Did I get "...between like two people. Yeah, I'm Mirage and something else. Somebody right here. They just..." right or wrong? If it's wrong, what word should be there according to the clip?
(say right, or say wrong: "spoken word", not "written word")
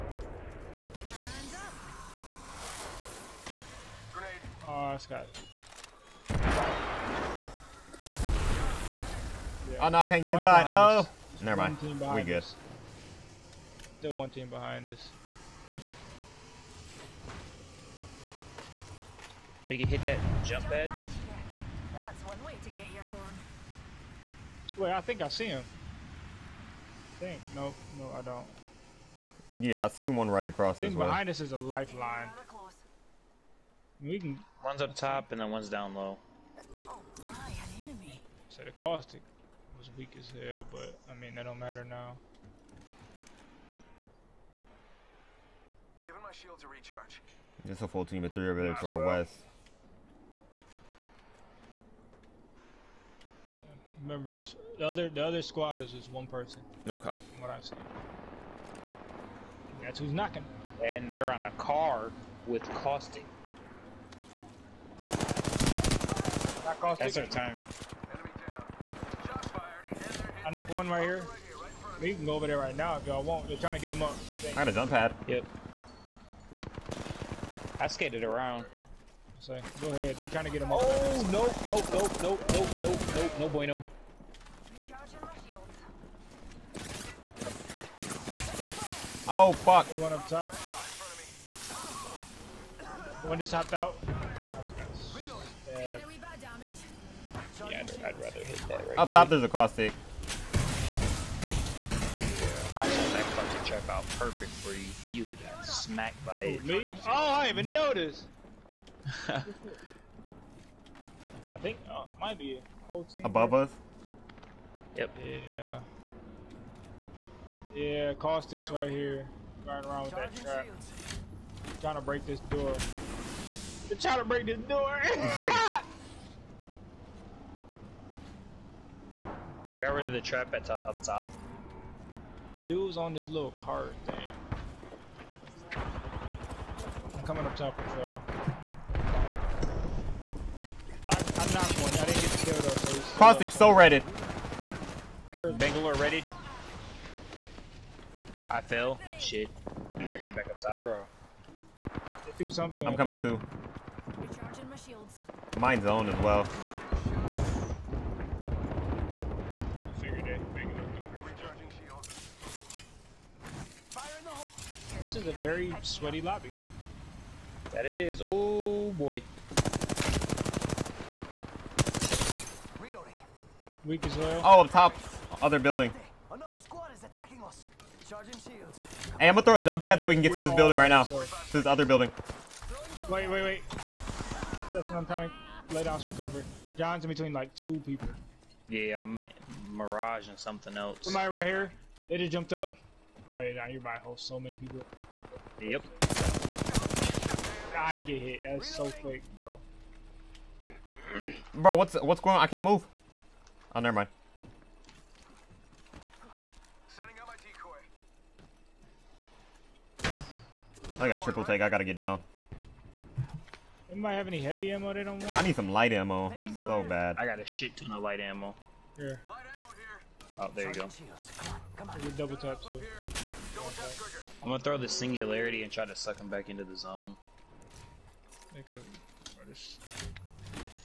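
right.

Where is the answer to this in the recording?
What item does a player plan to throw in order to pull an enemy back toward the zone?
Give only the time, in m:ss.
3:44.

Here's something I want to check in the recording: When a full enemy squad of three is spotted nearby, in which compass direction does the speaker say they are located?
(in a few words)
West.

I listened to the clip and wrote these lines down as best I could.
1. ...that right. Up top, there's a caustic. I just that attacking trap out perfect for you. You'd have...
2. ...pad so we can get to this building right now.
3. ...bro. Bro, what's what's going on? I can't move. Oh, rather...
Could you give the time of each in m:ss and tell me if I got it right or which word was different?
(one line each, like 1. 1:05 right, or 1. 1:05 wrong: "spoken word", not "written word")
1. 1:38 wrong: "fucking", not "attacking"
2. 2:59 right
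3. 3:19 wrong: "never", not "rather".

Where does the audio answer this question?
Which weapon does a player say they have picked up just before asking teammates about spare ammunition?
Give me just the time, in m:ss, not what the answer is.
3:31.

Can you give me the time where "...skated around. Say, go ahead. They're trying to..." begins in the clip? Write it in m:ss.
1:17.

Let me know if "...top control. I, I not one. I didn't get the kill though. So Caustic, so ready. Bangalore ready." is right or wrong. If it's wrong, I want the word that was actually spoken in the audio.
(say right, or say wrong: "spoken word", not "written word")
right.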